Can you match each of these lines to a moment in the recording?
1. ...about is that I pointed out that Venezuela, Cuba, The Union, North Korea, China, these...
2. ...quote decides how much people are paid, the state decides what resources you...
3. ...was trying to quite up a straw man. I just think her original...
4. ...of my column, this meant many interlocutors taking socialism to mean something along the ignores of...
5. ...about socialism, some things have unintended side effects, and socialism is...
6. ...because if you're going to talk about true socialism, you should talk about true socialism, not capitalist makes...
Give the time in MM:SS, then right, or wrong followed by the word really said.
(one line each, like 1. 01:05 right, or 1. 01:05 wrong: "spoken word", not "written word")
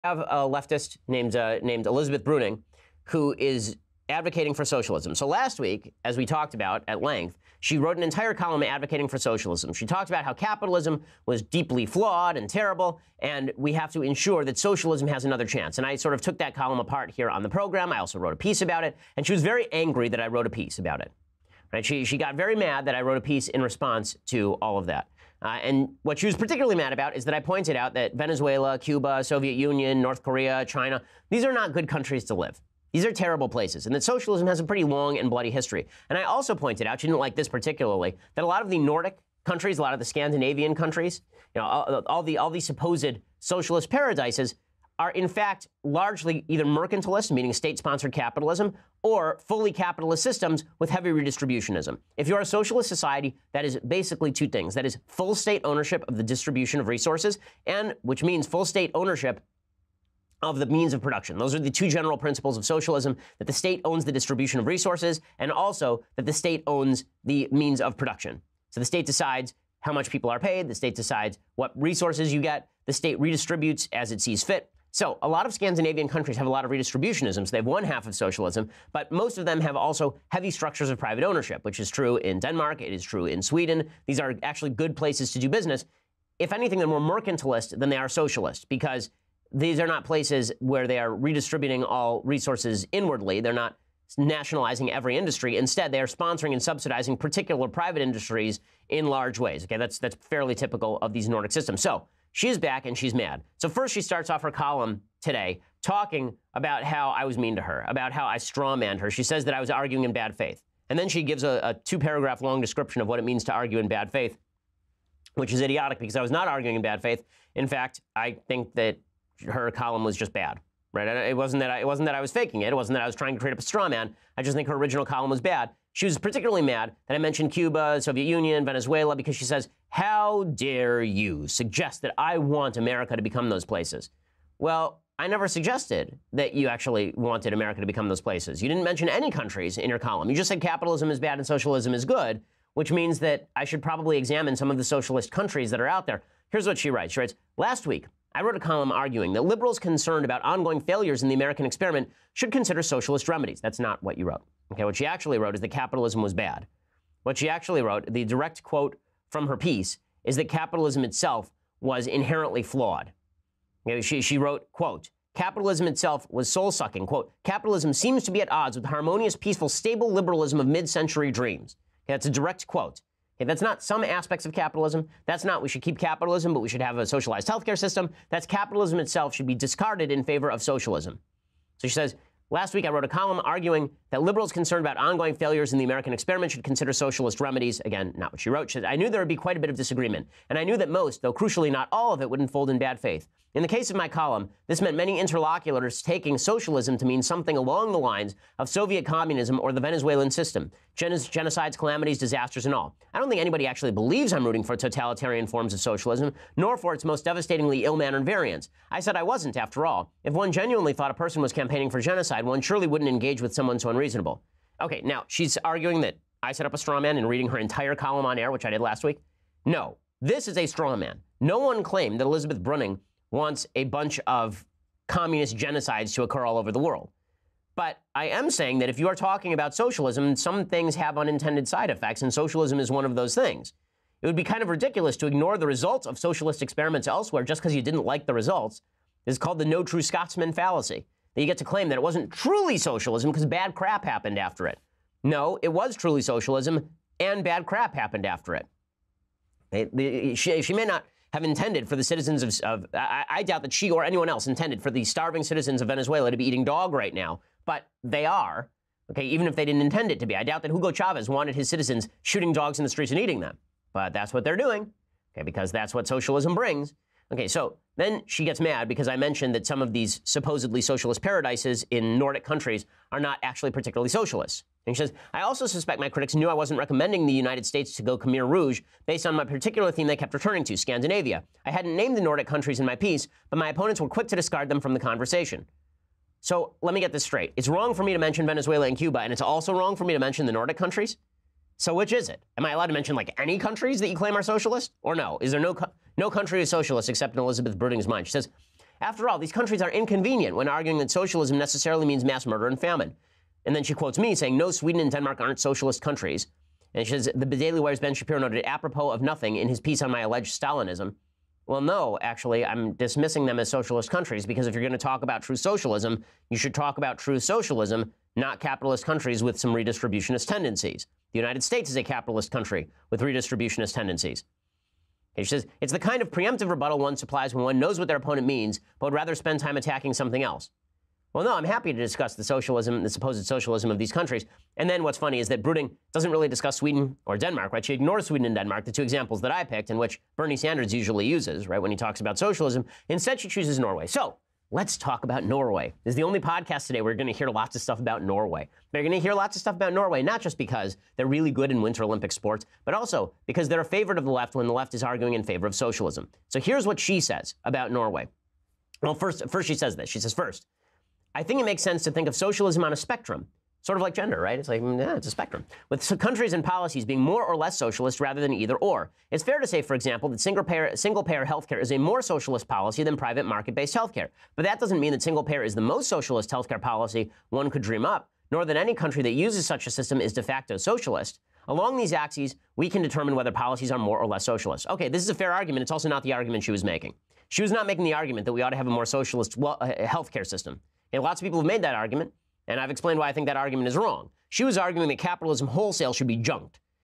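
1. 00:26 wrong: "Soviet", not "The"
2. 01:08 wrong: "state", not "quote"
3. 02:03 wrong: "create", not "quite"
4. 03:13 wrong: "lines", not "ignores"
5. 03:49 right
6. 05:14 wrong: "countries", not "makes".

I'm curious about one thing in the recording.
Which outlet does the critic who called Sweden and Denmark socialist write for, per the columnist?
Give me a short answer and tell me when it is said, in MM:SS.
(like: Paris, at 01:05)
The Daily Wire, at 05:07.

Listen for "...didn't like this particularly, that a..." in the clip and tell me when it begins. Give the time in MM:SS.
00:37.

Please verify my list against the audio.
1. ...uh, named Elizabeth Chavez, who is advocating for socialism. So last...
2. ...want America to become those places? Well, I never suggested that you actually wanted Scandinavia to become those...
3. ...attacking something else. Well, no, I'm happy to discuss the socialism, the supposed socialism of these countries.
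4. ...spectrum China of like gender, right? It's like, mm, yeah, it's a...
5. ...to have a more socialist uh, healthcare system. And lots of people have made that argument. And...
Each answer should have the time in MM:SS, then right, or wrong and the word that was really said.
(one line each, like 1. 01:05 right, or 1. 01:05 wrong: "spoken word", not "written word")
1. 00:01 wrong: "Bruenig", not "Chavez"
2. 02:12 wrong: "America", not "Scandinavia"
3. 05:29 right
4. 06:02 wrong: "Sort", not "China"
5. 06:28 right.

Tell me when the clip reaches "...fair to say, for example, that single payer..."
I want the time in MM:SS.
06:09.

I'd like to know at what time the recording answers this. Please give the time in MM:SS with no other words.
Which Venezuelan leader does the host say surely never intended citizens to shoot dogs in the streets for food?
04:20.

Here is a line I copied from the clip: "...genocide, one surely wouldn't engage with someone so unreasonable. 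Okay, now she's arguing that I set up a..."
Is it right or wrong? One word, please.
right.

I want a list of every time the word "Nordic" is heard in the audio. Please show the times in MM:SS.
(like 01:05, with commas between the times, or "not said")
00:38, 01:41, 04:32, 04:42, 04:50.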